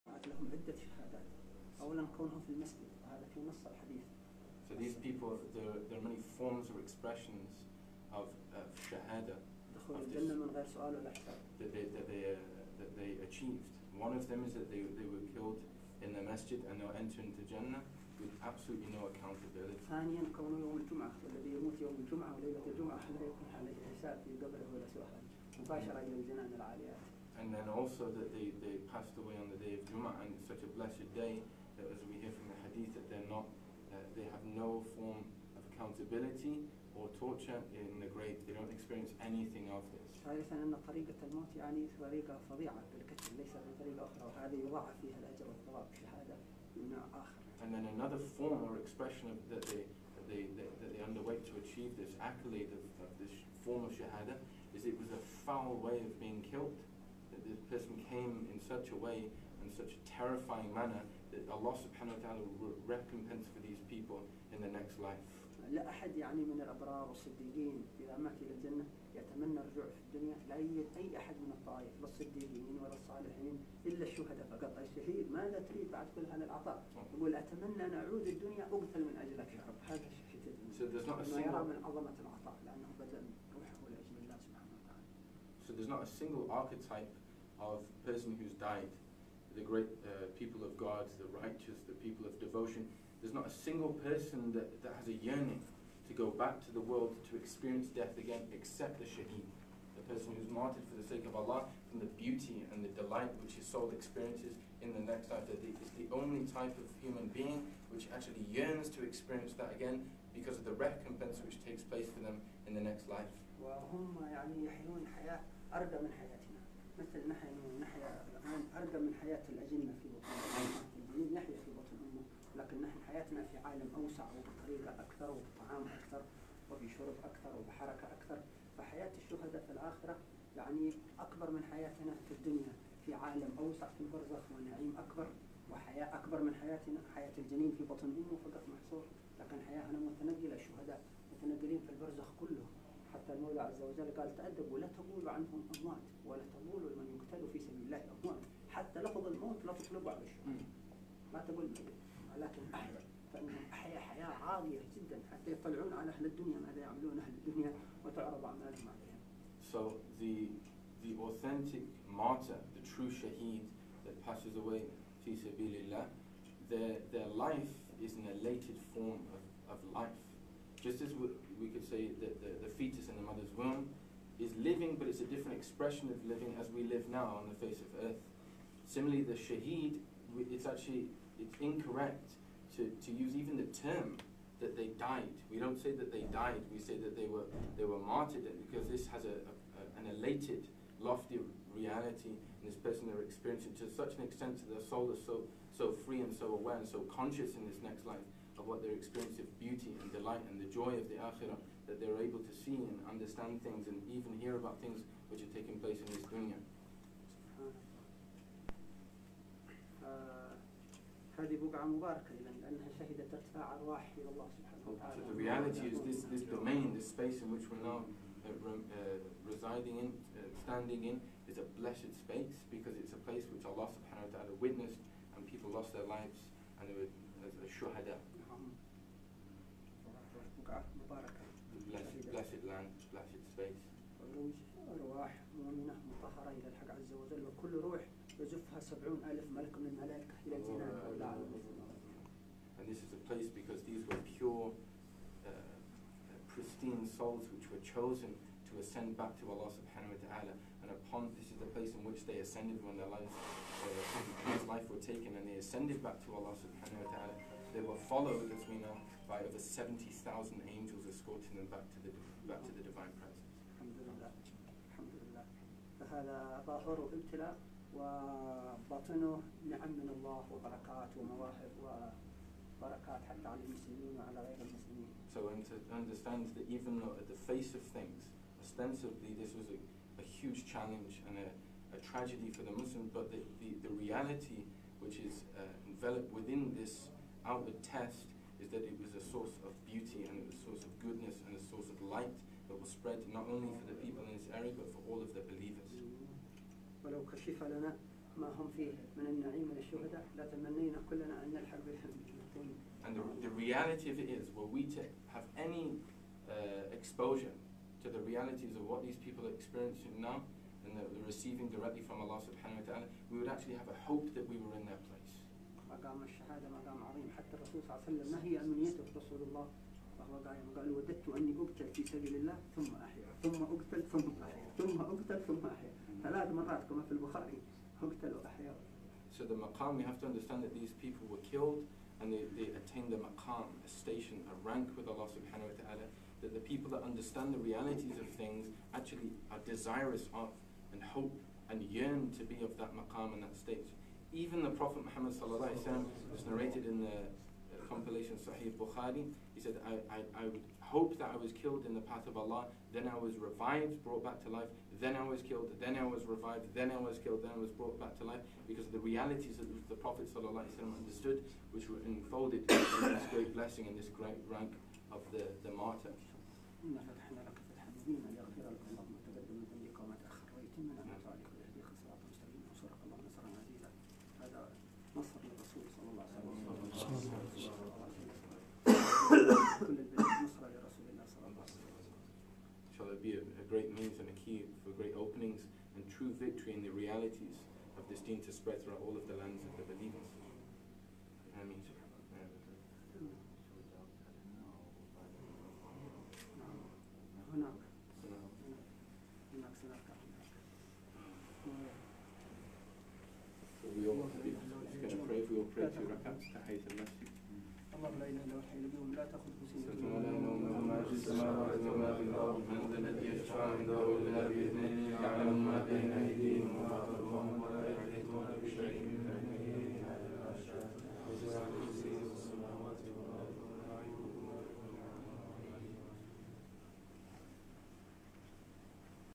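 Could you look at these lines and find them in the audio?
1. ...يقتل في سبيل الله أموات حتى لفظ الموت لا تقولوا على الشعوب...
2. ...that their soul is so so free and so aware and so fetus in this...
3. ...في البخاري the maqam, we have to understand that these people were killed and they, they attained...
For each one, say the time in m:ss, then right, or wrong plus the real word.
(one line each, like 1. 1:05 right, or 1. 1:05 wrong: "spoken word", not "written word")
1. 2:27 wrong: "تطلبوا", not "تقولوا"
2. 3:14 wrong: "conscious", not "fetus"
3. 5:27 right.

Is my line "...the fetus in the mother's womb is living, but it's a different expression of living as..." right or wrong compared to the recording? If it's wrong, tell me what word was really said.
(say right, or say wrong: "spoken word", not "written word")
right.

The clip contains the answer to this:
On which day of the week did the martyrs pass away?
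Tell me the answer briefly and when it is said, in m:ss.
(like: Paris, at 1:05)
Jum'ah, at 0:29.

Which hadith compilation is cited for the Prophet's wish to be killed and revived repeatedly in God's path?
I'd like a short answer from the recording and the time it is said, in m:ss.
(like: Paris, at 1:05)
Sahih Bukhari, at 5:48.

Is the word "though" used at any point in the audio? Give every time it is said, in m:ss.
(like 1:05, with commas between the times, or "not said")
4:36.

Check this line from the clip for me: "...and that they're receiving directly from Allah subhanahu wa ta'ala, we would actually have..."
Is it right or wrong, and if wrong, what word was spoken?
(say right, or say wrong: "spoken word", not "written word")
right.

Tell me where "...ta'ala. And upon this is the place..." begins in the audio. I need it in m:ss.
4:10.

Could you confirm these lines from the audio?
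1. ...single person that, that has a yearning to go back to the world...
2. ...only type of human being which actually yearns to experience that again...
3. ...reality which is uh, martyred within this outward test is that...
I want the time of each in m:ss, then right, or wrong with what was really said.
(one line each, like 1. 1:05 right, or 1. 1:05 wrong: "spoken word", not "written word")
1. 1:33 right
2. 1:46 right
3. 4:44 wrong: "enveloped", not "martyred".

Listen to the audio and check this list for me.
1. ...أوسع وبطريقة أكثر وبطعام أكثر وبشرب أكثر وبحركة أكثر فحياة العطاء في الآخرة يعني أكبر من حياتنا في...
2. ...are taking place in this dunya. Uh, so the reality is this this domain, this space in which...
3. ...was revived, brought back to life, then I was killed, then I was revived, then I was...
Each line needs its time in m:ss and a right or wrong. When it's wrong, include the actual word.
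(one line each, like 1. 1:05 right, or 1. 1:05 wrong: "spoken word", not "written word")
1. 2:03 wrong: "الشهداء", not "العطاء"
2. 3:25 right
3. 5:53 right.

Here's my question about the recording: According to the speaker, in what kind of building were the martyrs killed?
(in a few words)
the masjid.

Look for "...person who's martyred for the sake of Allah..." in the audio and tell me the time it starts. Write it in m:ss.
1:40.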